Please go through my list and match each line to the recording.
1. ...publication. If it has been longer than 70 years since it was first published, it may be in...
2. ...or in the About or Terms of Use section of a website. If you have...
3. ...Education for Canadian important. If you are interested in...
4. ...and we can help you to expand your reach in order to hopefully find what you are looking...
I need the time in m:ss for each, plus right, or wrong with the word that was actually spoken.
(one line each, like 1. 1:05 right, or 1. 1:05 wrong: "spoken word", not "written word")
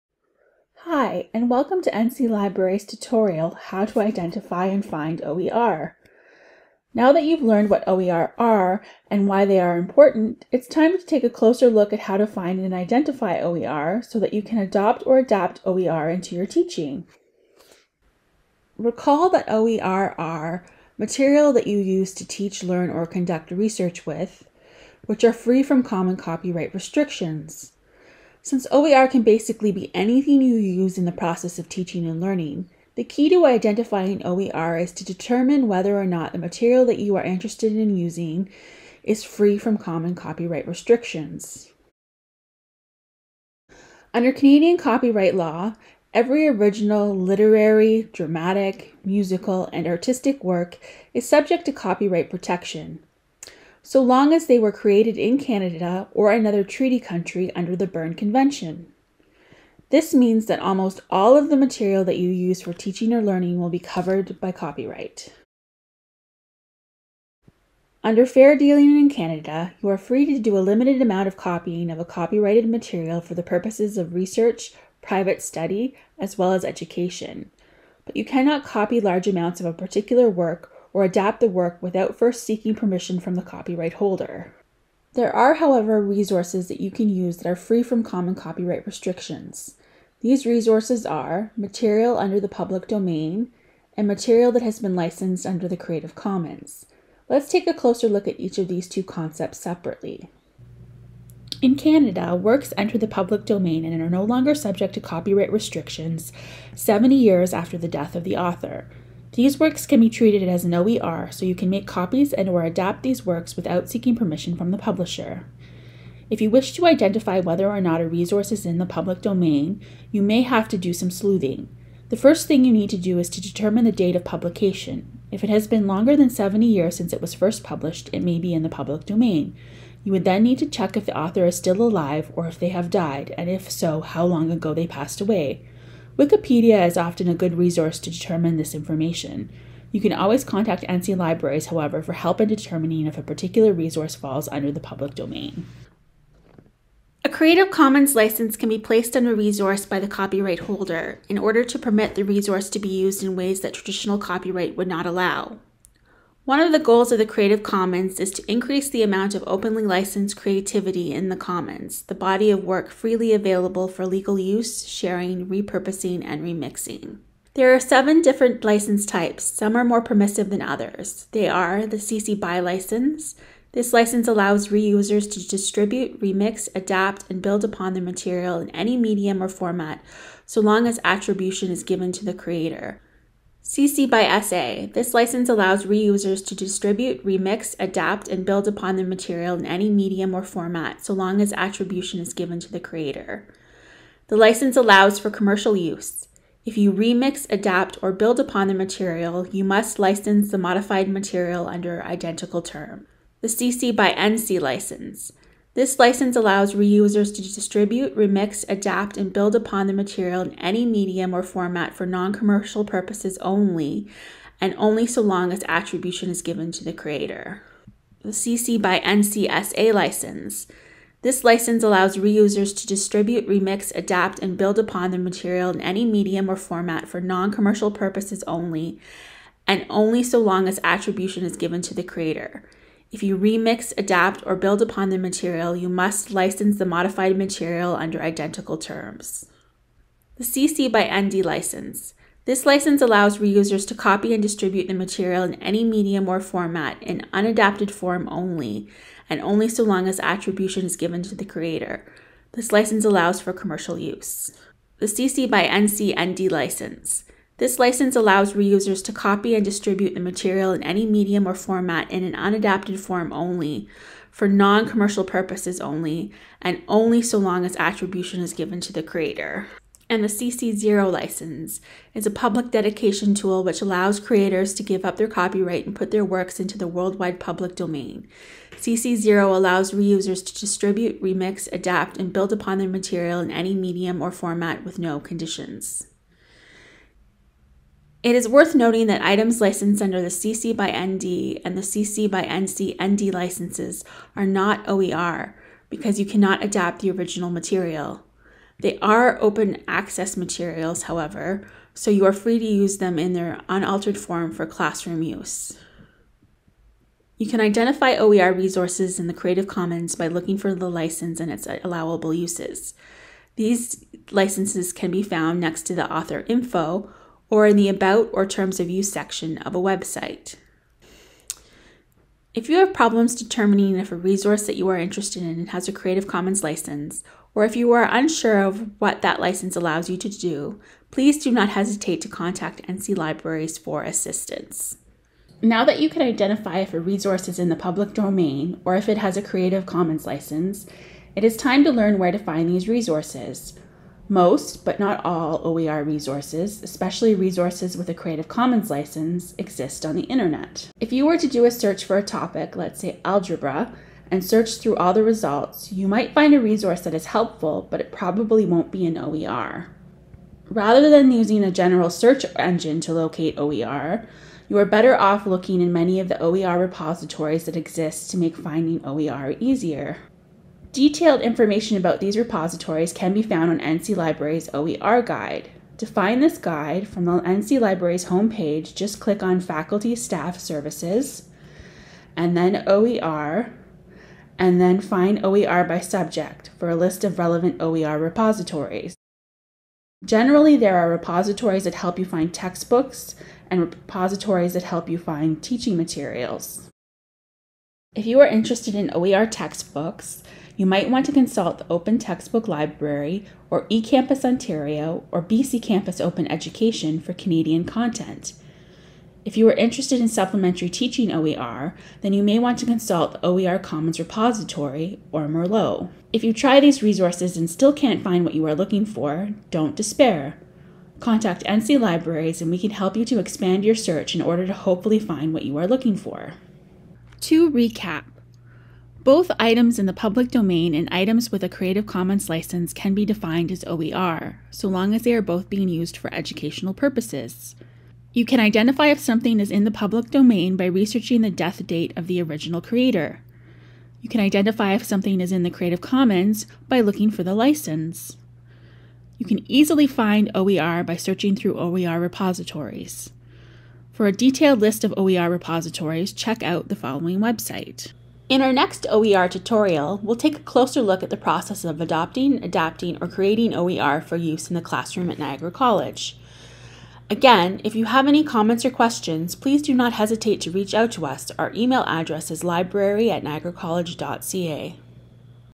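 1. 2:04 right
2. 5:17 right
3. 6:46 wrong: "content", not "important"
4. 7:02 wrong: "search", not "reach".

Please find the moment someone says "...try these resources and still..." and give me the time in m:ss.
6:56.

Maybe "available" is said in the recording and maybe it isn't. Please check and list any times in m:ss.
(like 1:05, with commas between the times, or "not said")
2:43.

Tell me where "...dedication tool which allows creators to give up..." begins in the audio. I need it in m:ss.
4:32.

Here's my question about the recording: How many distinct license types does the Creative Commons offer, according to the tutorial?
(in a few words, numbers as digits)
7.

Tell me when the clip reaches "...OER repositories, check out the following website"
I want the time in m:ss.
7:35.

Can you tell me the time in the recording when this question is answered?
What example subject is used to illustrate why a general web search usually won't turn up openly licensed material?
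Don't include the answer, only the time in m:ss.
5:53.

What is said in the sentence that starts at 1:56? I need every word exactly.
If you wish to identify whether or not a resource is in the public domain, you may have to do some sleuthing.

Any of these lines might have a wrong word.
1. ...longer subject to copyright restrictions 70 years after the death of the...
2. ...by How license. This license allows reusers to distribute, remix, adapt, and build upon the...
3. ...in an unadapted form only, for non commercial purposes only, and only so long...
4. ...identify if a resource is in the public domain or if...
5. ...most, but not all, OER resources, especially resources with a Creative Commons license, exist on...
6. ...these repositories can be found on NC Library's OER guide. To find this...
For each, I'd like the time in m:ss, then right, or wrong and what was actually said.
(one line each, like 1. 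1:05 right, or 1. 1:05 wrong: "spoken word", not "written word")
1. 1:44 right
2. 3:38 wrong: "NCSA", not "How"
3. 4:22 right
4. 5:36 right
5. 5:44 right
6. 6:12 right.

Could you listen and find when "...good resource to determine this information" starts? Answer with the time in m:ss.
2:17.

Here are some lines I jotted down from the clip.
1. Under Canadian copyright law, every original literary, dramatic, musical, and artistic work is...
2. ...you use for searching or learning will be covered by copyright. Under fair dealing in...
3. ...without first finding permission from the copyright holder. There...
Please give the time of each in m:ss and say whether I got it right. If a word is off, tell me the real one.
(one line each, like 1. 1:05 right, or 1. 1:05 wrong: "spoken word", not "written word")
1. 0:44 right
2. 1:02 wrong: "teaching", not "searching"
3. 1:21 wrong: "seeking", not "finding".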